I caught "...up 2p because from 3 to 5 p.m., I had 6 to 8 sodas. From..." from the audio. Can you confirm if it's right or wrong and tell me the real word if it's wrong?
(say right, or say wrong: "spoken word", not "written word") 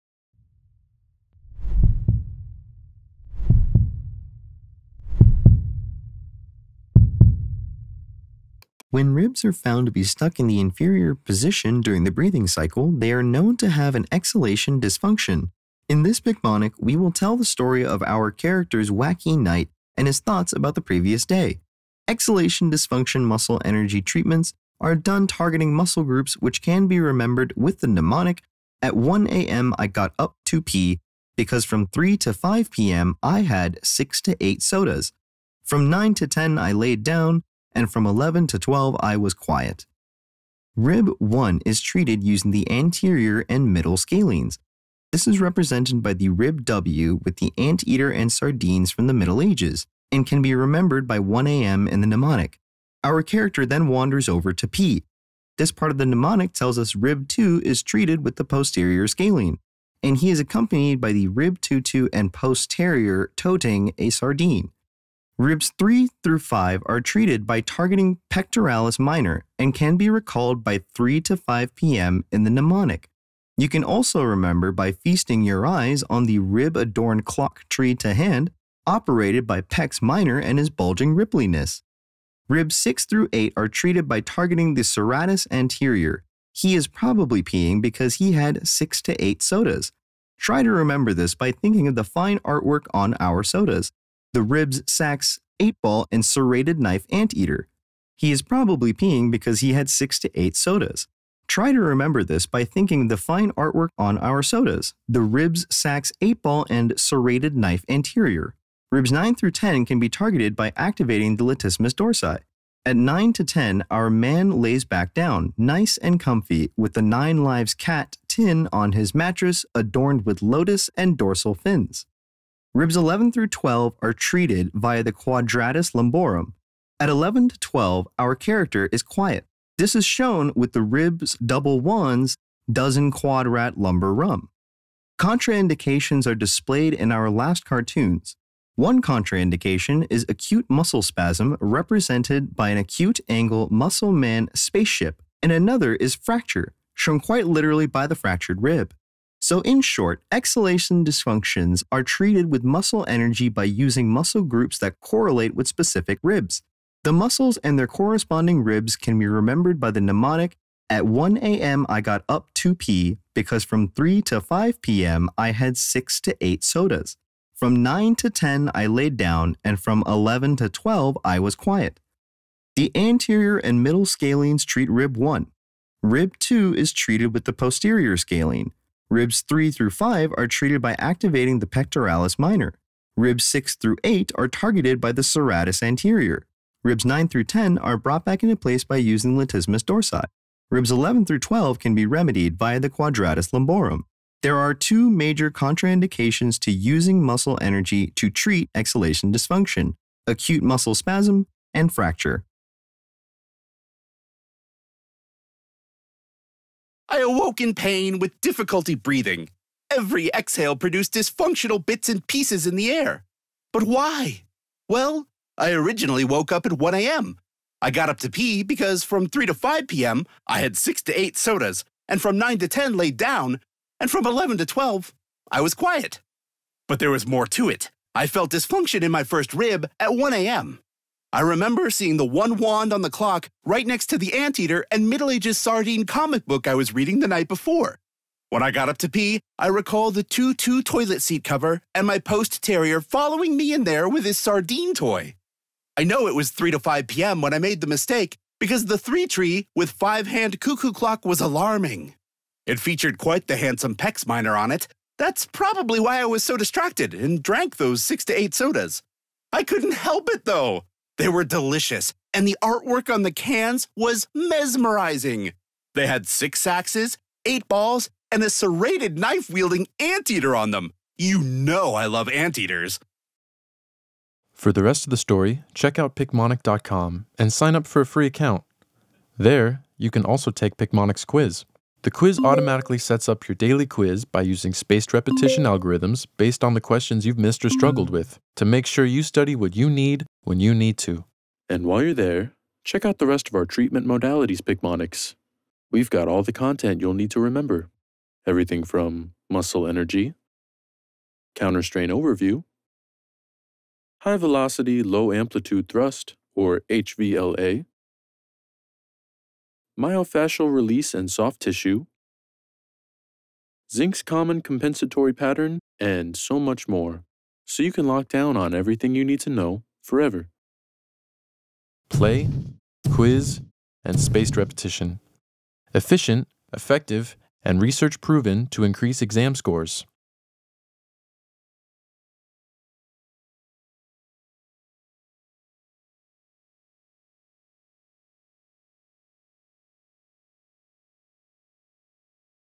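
right.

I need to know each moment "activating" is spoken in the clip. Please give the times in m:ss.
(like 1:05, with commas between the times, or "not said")
1:50, 3:00.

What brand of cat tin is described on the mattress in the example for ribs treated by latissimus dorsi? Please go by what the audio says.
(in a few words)
Nine Lives.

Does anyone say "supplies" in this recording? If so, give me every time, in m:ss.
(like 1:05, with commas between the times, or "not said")
not said.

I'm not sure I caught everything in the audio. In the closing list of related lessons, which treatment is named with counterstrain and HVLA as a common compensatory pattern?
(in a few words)
Zink's.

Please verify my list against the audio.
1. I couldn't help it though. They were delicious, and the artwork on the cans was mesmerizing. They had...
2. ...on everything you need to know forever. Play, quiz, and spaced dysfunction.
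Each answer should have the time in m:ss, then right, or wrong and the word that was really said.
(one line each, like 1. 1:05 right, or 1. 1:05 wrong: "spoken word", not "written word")
1. 4:19 right
2. 5:18 wrong: "repetition", not "dysfunction".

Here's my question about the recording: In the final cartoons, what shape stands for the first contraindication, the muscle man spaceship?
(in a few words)
Acute angle.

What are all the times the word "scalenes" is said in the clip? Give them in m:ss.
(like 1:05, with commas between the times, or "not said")
0:43, 0:59, 2:54, 2:58.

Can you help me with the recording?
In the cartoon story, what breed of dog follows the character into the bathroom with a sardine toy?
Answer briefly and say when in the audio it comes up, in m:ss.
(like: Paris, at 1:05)
Post terrier, at 4:02.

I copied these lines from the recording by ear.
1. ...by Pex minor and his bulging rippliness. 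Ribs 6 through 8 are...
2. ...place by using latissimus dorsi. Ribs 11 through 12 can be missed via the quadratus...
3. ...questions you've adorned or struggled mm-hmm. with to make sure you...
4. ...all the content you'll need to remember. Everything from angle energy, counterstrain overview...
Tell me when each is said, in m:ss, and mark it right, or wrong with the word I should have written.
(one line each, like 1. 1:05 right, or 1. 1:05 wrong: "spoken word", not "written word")
1. 1:19 right
2. 3:08 wrong: "remedied", not "missed"
3. 4:46 wrong: "missed", not "adorned"
4. 4:56 wrong: "muscle", not "angle".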